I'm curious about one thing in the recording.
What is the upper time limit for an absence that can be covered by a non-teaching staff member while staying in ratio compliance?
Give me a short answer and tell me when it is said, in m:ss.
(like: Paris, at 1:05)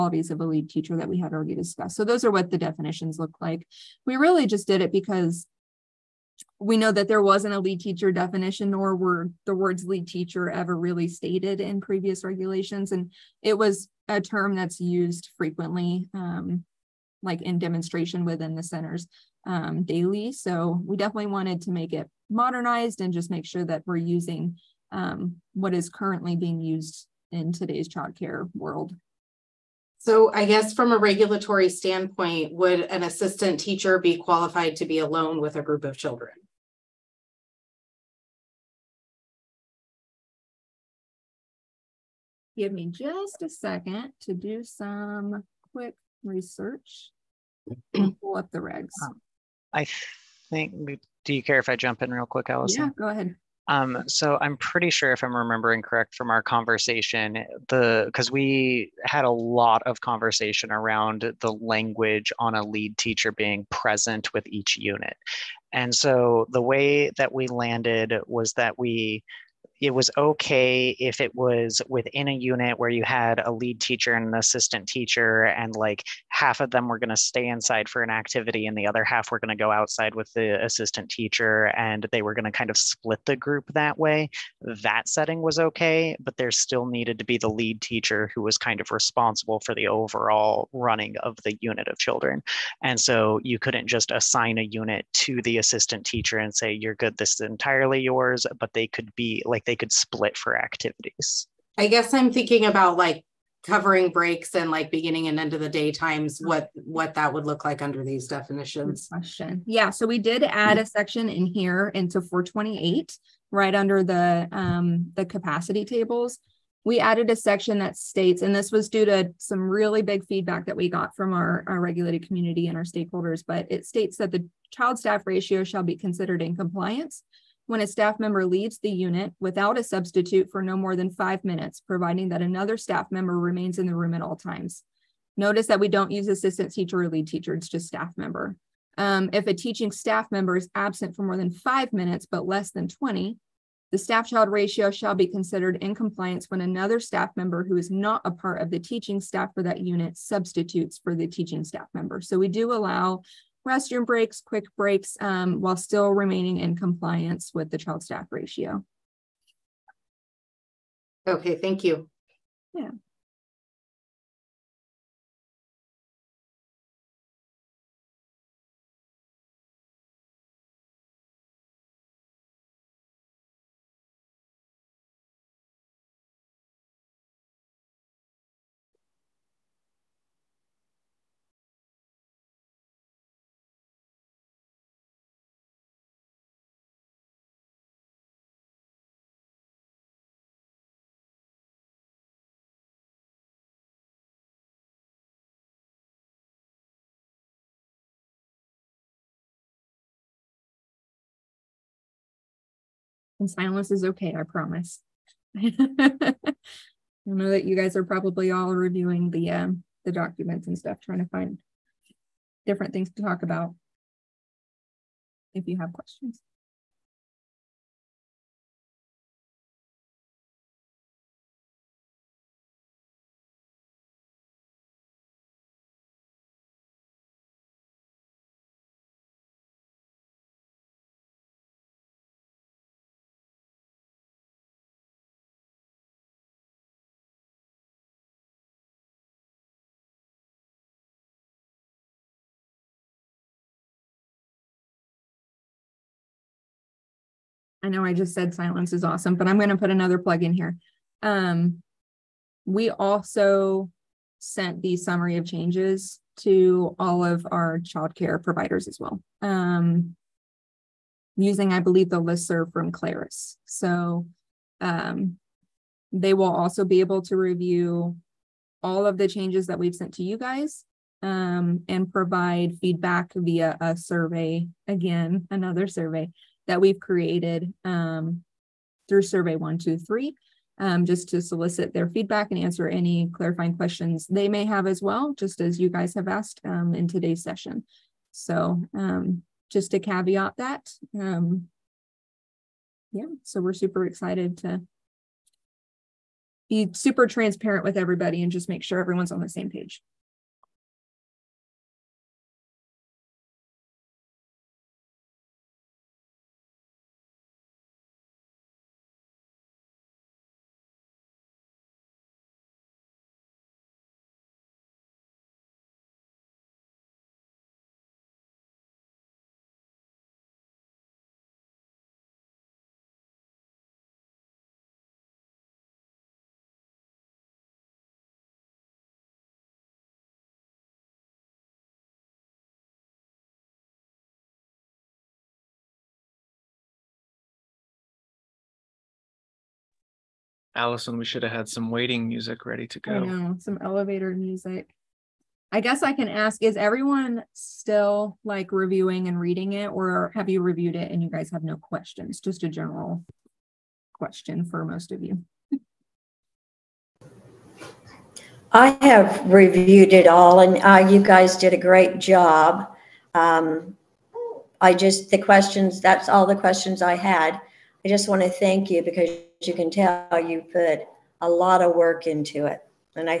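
20 minutes, at 2:22.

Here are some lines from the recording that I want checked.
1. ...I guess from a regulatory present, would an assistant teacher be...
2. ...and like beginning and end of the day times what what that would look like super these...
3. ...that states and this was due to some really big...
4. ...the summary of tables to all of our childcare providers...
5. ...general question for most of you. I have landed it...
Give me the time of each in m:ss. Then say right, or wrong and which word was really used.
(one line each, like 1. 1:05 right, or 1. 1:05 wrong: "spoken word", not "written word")
1. 0:30 wrong: "standpoint", not "present"
2. 1:44 wrong: "under", not "super"
3. 1:57 right
4. 4:14 wrong: "changes", not "tables"
5. 5:52 wrong: "reviewed", not "landed".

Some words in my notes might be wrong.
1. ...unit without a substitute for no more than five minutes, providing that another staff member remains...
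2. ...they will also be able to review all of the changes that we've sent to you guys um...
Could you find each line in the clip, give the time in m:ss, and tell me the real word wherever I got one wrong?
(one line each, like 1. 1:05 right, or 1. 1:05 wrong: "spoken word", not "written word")
1. 2:08 right
2. 4:26 right.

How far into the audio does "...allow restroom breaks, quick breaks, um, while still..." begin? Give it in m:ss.
2:32.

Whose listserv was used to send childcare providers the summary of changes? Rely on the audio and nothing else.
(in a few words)
Claris.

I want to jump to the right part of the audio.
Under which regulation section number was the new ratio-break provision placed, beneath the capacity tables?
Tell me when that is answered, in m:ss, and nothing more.
1:52.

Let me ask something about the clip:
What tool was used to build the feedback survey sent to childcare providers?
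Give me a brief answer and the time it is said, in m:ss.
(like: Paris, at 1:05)
Survey 123, at 4:39.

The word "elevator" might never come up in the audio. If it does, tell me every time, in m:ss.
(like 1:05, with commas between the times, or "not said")
5:43.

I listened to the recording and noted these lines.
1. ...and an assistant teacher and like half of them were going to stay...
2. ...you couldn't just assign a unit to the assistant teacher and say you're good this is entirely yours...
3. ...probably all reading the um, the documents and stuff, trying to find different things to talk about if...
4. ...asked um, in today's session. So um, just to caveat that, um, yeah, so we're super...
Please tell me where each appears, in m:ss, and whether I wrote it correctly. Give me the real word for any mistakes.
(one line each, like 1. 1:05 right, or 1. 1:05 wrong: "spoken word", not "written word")
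1. 1:14 right
2. 1:33 right
3. 3:28 wrong: "reviewing", not "reading"
4. 4:46 right.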